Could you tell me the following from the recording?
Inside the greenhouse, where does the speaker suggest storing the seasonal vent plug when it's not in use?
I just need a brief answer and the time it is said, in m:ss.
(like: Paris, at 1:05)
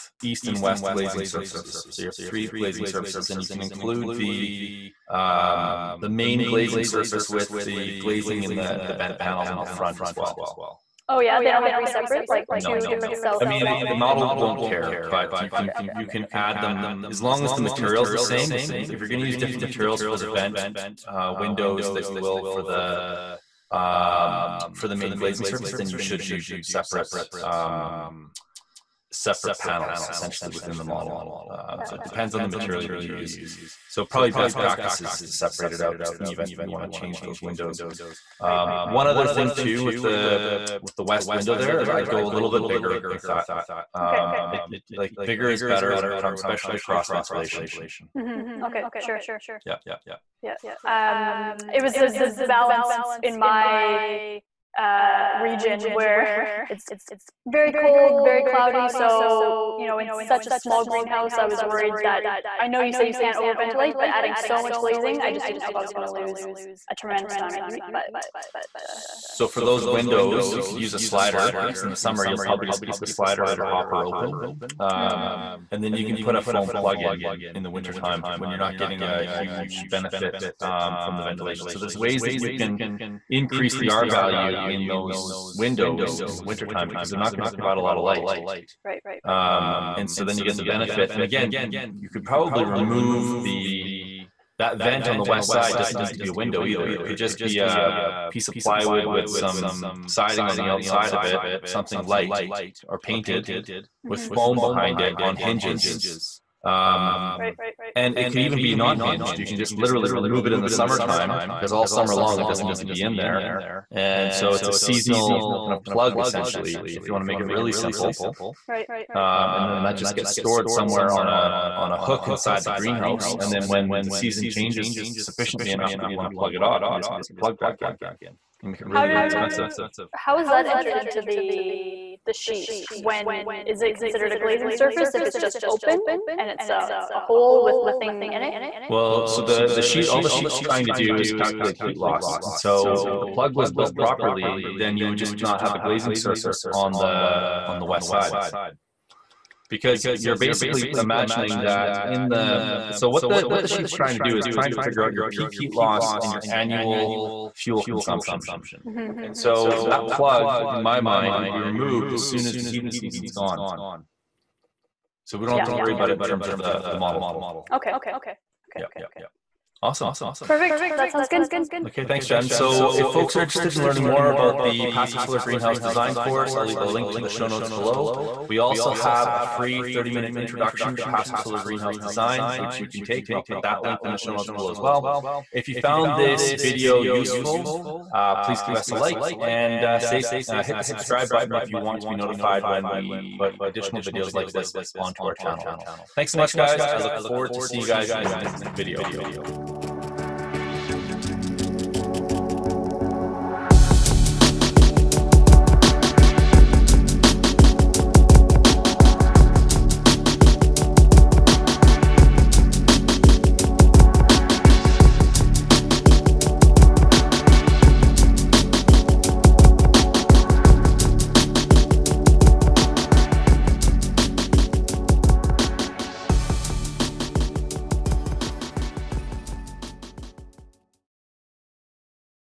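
On a hook, at 2:01.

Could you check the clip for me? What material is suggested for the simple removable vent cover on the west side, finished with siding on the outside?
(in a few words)
Plywood.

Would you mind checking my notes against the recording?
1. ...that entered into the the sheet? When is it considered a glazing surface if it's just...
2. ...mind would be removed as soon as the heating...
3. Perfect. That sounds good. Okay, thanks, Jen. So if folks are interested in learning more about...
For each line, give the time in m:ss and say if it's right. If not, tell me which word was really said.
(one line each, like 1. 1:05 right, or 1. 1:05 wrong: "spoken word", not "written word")
1. 2:10 right
2. 2:40 right
3. 2:50 right.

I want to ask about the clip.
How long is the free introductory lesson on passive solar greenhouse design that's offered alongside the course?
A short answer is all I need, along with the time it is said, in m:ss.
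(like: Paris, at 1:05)
30 minutes, at 2:59.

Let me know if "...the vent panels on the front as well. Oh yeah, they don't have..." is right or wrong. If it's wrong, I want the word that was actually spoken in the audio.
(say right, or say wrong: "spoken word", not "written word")
right.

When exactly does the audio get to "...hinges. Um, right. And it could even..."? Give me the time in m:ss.
1:45.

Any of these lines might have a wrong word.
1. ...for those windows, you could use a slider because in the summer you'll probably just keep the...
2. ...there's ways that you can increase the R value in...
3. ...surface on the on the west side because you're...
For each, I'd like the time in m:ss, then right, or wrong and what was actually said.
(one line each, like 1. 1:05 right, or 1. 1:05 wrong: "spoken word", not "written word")
1. 1:09 right
2. 1:21 right
3. 2:26 right.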